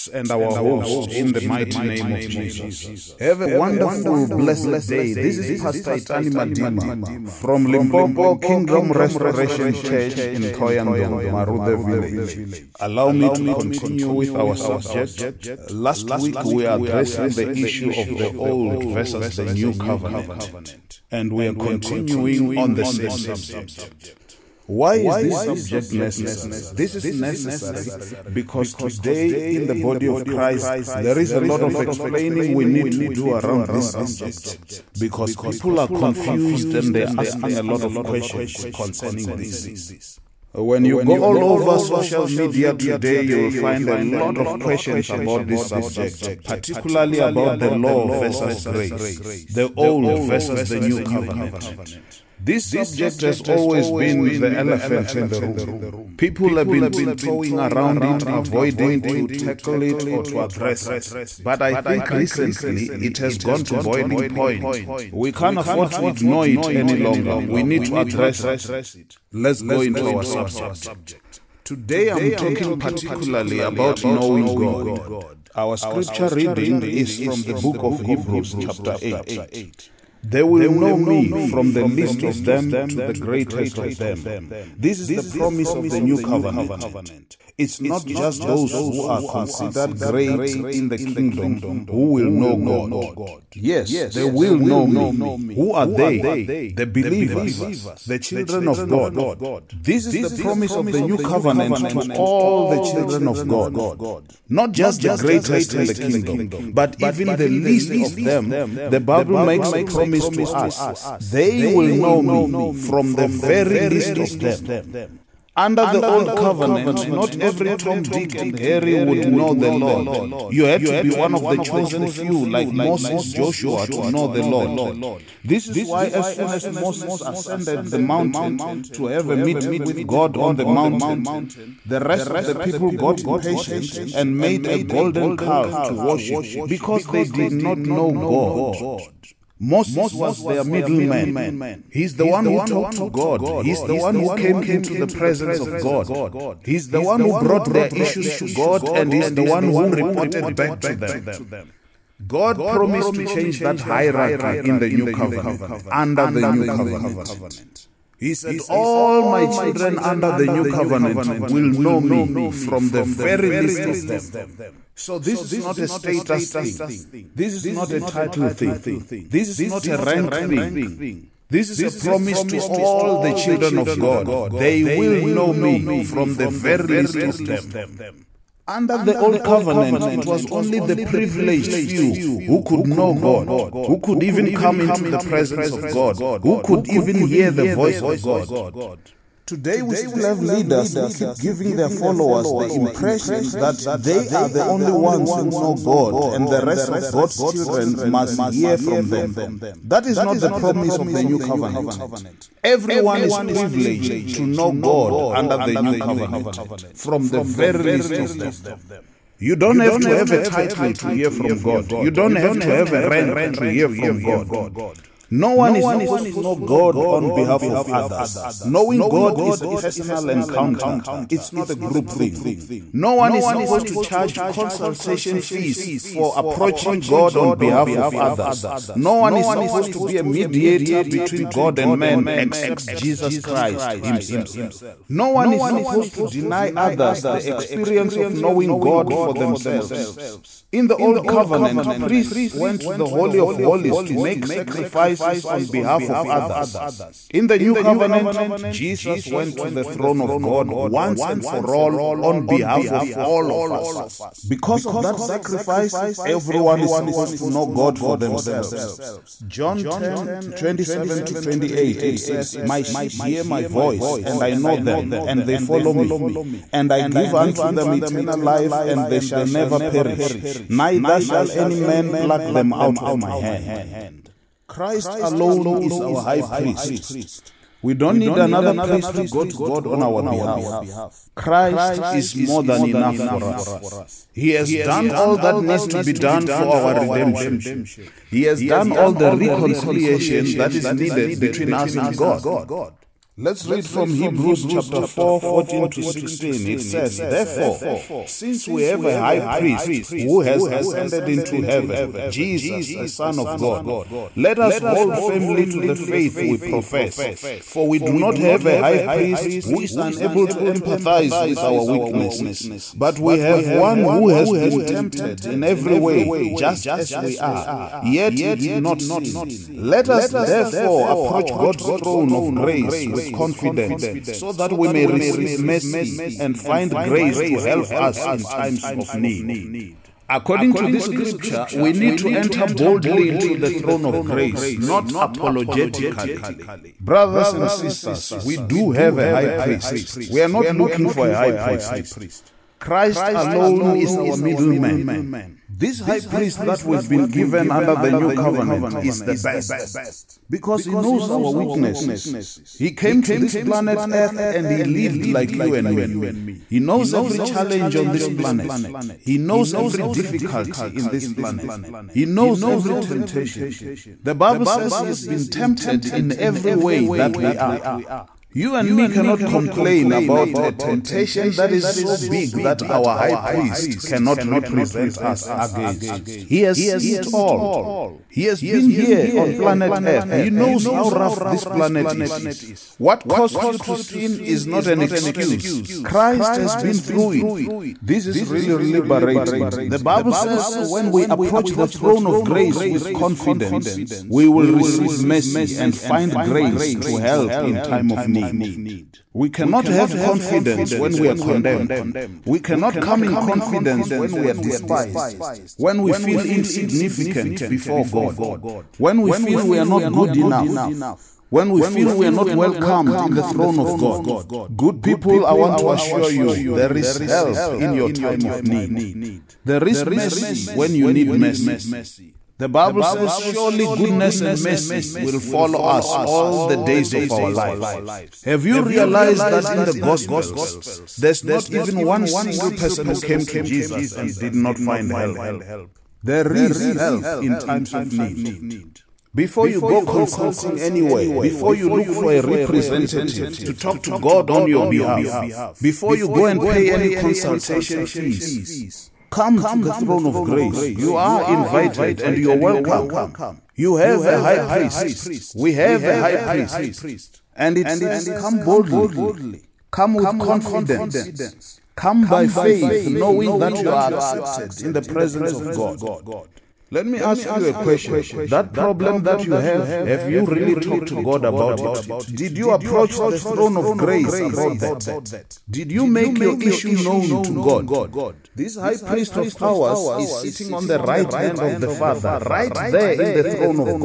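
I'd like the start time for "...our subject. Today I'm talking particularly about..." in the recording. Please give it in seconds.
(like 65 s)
70 s.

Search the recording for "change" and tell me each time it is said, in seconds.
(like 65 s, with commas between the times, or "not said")
153 s.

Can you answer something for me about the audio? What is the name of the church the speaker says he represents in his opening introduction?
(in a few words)
Limpopo Kingdom Restoration Church.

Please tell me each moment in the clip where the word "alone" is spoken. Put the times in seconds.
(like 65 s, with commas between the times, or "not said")
275 s, 343 s.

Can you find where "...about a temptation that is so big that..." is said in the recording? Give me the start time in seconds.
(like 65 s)
370 s.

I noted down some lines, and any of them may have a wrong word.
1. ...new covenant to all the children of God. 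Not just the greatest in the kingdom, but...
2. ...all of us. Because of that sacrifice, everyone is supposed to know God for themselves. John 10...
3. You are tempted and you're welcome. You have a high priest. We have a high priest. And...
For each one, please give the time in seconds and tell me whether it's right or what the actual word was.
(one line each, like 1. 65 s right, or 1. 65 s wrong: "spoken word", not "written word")
1. 101 s right
2. 253 s right
3. 450 s wrong: "invited", not "tempted".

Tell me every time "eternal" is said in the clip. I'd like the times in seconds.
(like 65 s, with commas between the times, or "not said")
267 s.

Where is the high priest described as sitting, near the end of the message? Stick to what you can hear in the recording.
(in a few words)
Right hand of the Father.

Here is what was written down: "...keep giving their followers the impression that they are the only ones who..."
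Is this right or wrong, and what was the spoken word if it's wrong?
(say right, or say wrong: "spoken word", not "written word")
right.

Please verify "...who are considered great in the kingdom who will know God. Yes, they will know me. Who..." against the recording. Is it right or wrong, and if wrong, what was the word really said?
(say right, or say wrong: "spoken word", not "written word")
right.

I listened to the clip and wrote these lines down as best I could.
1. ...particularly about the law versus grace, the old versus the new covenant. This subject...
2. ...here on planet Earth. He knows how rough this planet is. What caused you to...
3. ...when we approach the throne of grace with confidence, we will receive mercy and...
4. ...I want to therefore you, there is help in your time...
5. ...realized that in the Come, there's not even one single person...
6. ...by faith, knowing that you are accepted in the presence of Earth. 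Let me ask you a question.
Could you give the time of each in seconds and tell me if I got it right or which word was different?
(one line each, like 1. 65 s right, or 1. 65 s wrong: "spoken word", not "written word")
1. 46 s right
2. 378 s right
3. 390 s right
4. 415 s wrong: "assure", not "therefore"
5. 428 s wrong: "Gospels", not "Come"
6. 462 s wrong: "God", not "Earth".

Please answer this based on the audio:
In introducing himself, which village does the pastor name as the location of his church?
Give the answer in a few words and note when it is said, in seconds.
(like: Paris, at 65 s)
Marude Village, at 11 s.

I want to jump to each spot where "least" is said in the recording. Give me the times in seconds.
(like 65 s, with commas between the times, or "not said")
81 s, 107 s, 113 s, 163 s, 176 s, 207 s.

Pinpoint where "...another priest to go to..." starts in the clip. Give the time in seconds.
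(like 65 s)
278 s.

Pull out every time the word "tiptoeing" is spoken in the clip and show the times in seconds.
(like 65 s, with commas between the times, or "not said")
56 s.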